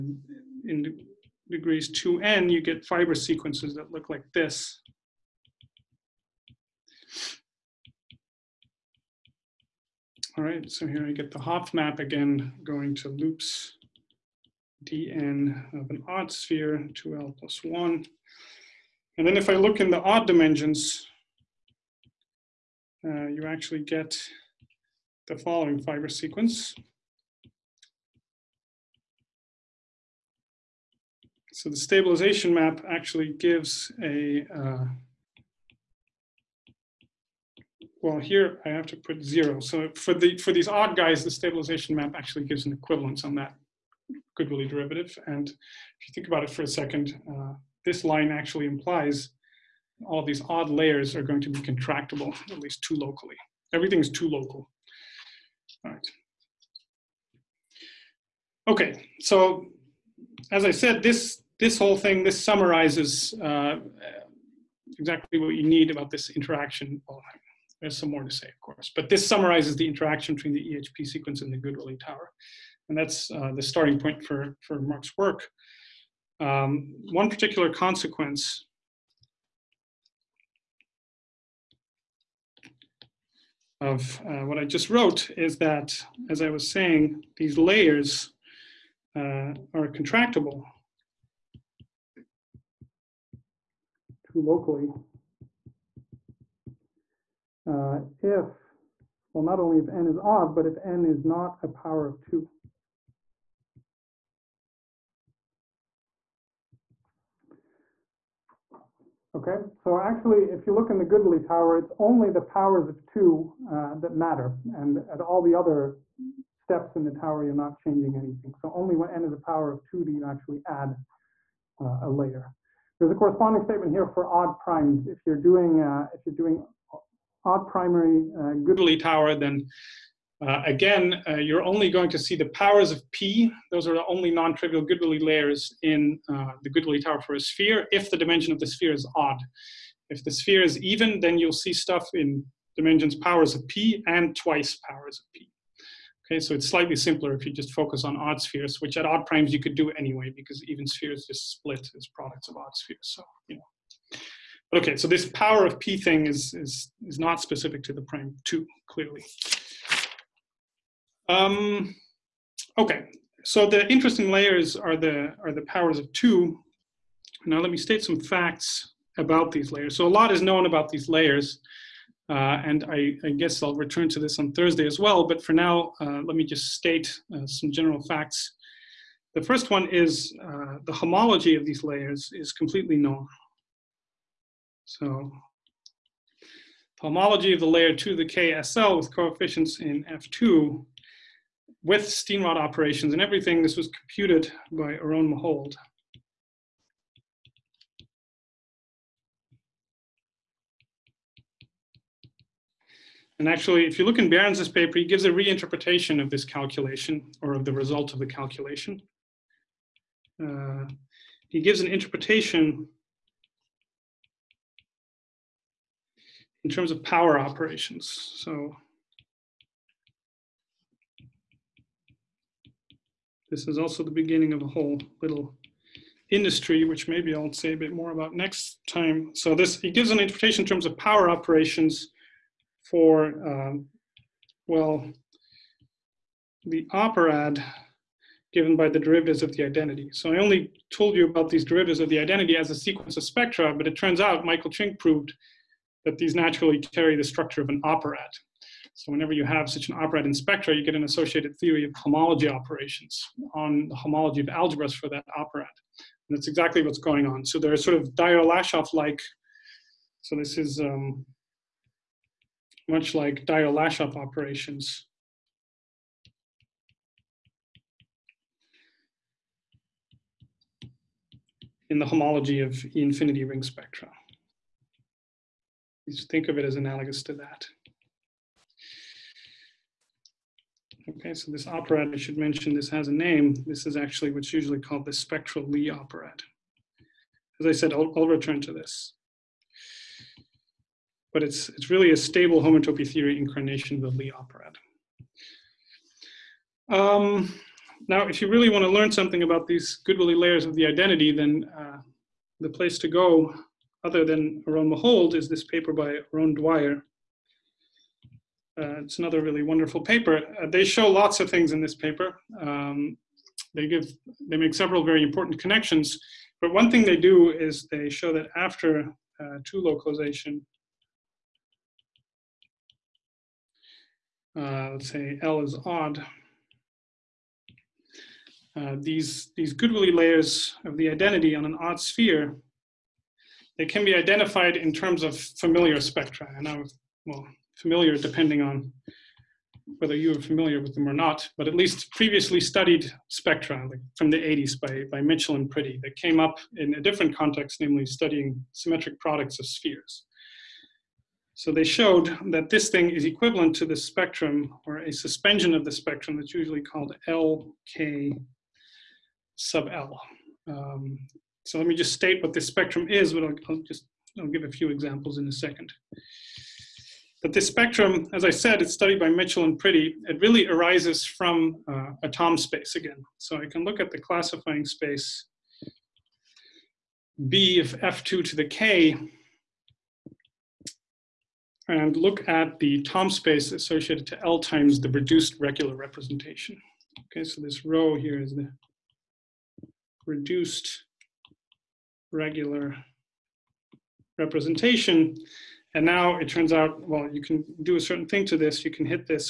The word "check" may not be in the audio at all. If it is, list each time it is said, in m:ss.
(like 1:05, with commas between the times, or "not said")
not said.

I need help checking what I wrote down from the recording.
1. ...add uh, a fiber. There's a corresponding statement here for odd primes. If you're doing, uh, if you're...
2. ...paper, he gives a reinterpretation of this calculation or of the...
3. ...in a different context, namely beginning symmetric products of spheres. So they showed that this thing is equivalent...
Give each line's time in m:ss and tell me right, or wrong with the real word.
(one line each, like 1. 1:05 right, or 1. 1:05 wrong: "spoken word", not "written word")
1. 2:00 wrong: "layer", not "fiber"
2. 3:24 right
3. 5:46 wrong: "studying", not "beginning".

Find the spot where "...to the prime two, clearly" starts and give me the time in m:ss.
2:37.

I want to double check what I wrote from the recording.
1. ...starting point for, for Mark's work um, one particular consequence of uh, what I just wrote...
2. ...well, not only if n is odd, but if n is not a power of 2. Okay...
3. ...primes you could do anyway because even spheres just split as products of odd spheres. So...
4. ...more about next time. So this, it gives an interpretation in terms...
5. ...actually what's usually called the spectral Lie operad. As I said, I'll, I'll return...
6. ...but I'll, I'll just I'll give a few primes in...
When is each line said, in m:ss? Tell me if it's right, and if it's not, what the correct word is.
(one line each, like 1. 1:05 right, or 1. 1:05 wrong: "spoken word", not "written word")
1. 1:13 right
2. 1:39 right
3. 2:29 right
4. 3:47 right
5. 4:43 right
6. 6:03 wrong: "examples", not "primes".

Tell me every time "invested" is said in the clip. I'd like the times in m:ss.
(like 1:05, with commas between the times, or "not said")
not said.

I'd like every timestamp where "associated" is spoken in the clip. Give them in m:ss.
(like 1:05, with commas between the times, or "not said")
4:11, 6:23.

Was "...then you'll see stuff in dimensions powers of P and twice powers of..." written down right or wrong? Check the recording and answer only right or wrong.
right.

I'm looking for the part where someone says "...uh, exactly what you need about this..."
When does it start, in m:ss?
1:03.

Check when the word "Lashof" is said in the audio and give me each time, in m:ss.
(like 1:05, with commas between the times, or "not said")
4:18, 4:23.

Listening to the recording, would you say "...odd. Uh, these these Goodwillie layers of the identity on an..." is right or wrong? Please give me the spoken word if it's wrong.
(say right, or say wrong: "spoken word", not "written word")
right.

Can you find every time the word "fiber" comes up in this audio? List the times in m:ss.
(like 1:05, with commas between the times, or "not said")
0:02, 0:25.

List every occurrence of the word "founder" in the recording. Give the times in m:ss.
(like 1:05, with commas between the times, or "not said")
not said.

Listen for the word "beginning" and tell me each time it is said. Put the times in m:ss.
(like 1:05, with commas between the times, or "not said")
3:44.